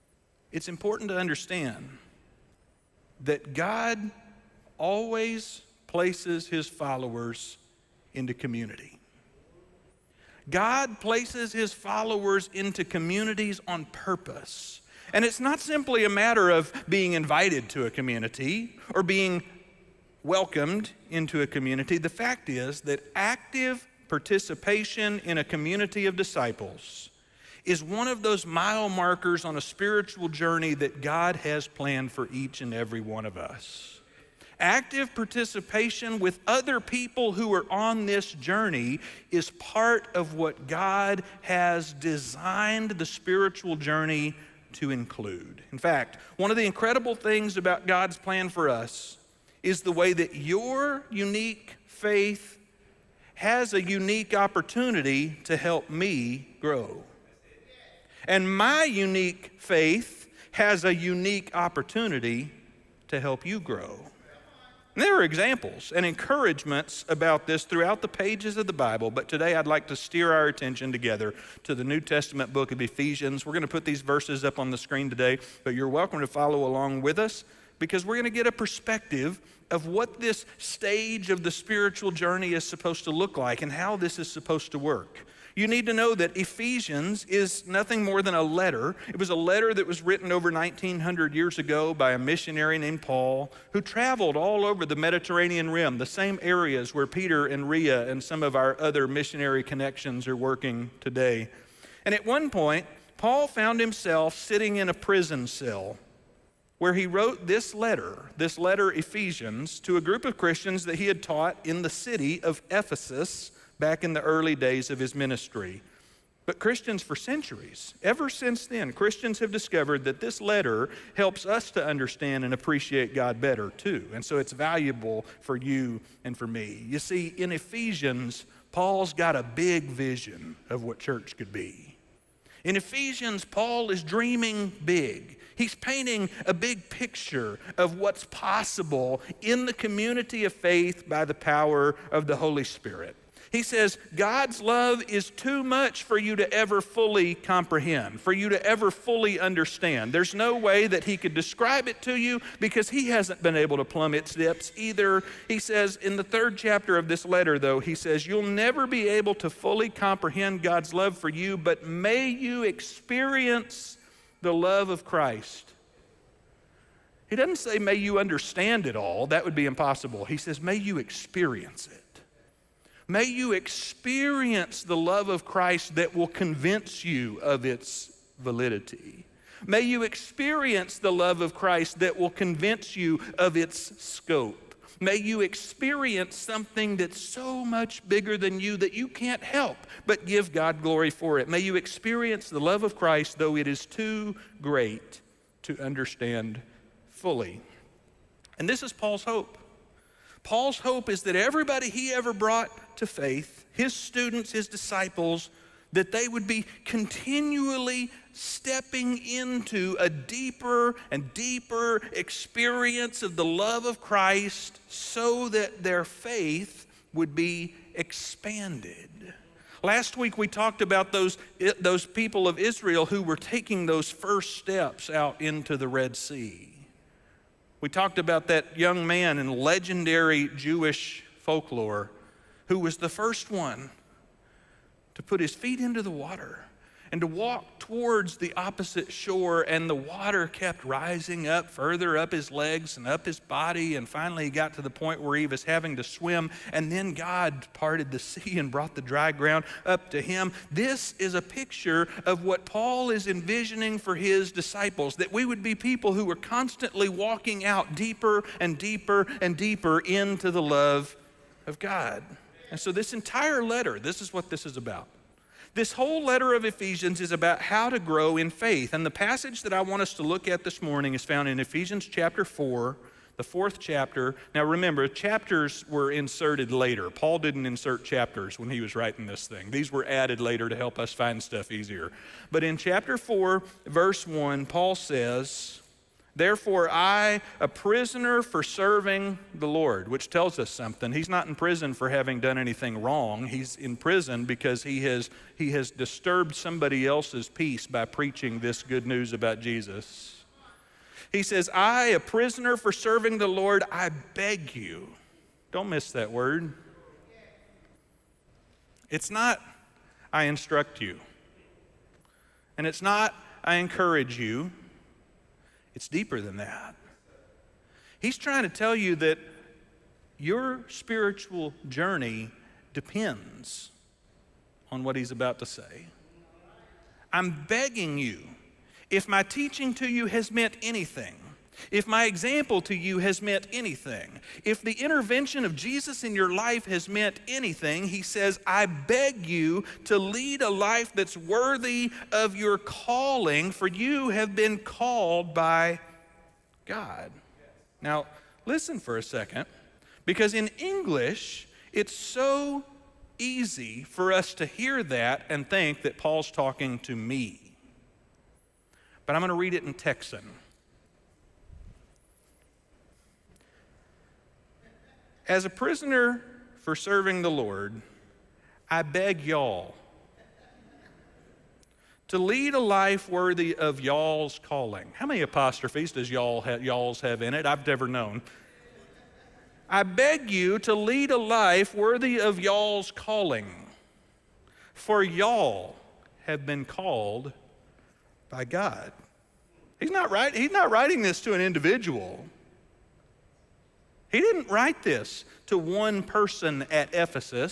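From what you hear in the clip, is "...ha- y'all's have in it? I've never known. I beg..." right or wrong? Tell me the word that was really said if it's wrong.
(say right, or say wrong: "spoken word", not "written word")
right.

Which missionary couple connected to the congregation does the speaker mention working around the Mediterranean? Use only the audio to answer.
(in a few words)
Peter and Rhea.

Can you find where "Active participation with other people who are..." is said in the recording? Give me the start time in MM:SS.
00:34.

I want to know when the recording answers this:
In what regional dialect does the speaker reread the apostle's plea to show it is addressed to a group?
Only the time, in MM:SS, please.
05:59.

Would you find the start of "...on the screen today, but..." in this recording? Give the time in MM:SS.
01:14.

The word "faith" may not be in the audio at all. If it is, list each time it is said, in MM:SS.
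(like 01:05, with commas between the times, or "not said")
00:51, 00:59, 02:20, 03:23, 03:36, 04:28.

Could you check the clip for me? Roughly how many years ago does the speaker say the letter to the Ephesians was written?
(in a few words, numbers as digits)
1900.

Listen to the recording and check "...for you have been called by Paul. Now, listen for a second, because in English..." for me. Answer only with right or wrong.
wrong.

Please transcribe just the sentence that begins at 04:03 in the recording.
And finally, he got to the point where he was having to swim.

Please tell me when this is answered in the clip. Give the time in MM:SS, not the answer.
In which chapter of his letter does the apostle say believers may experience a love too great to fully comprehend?
02:36.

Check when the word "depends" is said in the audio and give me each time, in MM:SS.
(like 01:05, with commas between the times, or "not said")
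05:22.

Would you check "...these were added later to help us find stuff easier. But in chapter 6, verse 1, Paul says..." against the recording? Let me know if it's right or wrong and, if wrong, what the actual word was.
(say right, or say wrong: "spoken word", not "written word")
wrong: "4", not "6".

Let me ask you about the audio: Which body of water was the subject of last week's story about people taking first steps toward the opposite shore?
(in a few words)
Red Sea.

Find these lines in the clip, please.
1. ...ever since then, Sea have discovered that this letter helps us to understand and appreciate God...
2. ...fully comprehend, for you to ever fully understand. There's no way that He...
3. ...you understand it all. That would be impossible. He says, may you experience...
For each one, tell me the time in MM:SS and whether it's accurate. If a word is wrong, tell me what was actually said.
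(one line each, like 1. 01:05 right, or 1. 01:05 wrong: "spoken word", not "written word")
1. 01:58 wrong: "Christians", not "Sea"
2. 02:26 right
3. 02:47 right.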